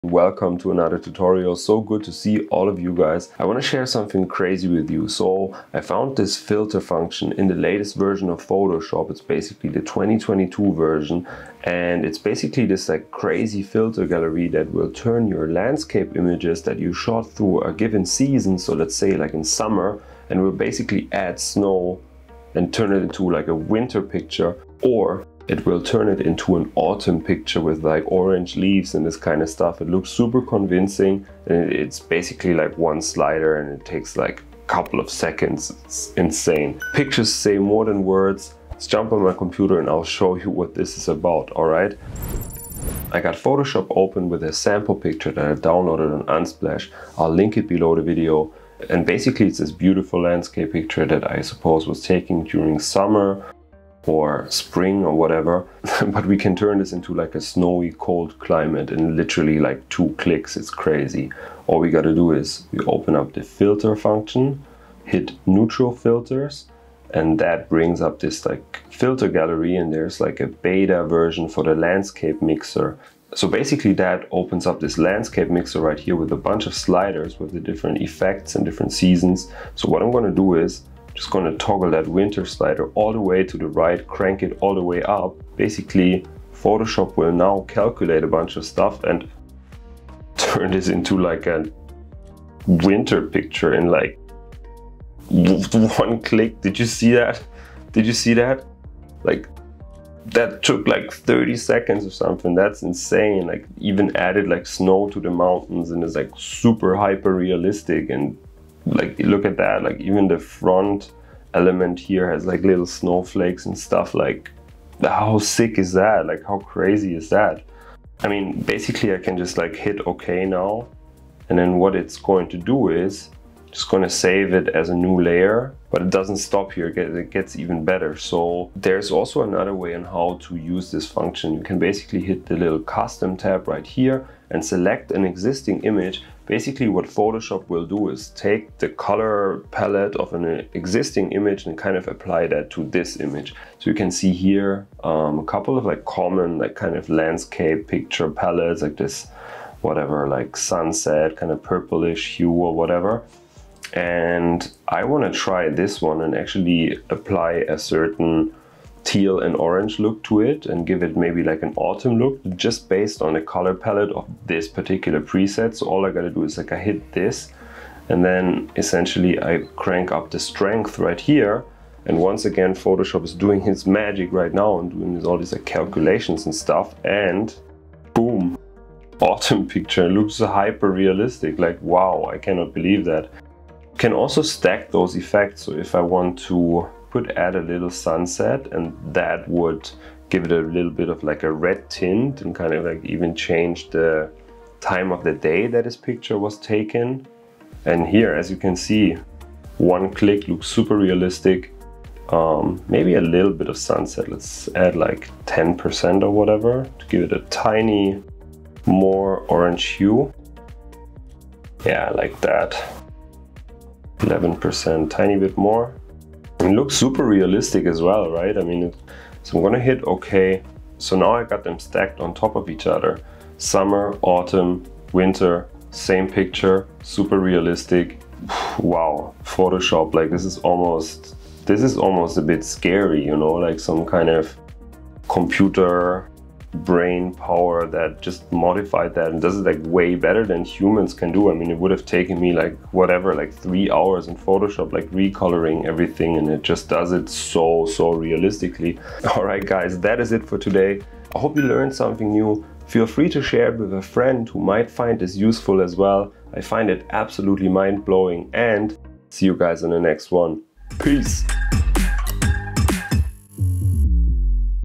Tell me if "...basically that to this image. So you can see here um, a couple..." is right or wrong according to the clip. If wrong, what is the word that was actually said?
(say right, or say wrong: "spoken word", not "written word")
wrong: "apply", not "basically".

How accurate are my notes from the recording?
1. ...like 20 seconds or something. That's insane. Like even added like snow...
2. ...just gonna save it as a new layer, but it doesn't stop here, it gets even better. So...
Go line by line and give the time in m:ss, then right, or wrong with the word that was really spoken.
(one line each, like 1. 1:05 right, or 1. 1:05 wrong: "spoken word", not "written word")
1. 1:40 wrong: "30", not "20"
2. 2:03 right.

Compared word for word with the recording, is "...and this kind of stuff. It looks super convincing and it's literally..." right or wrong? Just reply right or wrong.
wrong.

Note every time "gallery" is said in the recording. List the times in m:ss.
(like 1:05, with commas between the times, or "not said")
0:14, 1:09.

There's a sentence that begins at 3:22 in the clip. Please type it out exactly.
Um, maybe a little bit of sunset.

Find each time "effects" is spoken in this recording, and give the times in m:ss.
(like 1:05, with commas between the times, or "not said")
1:18, 3:05.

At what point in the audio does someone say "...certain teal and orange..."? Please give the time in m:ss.
2:37.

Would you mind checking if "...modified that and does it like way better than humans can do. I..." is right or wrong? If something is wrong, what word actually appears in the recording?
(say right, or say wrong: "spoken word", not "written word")
right.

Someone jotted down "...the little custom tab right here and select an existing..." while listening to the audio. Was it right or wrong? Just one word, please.
right.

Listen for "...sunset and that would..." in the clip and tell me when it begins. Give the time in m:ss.
3:07.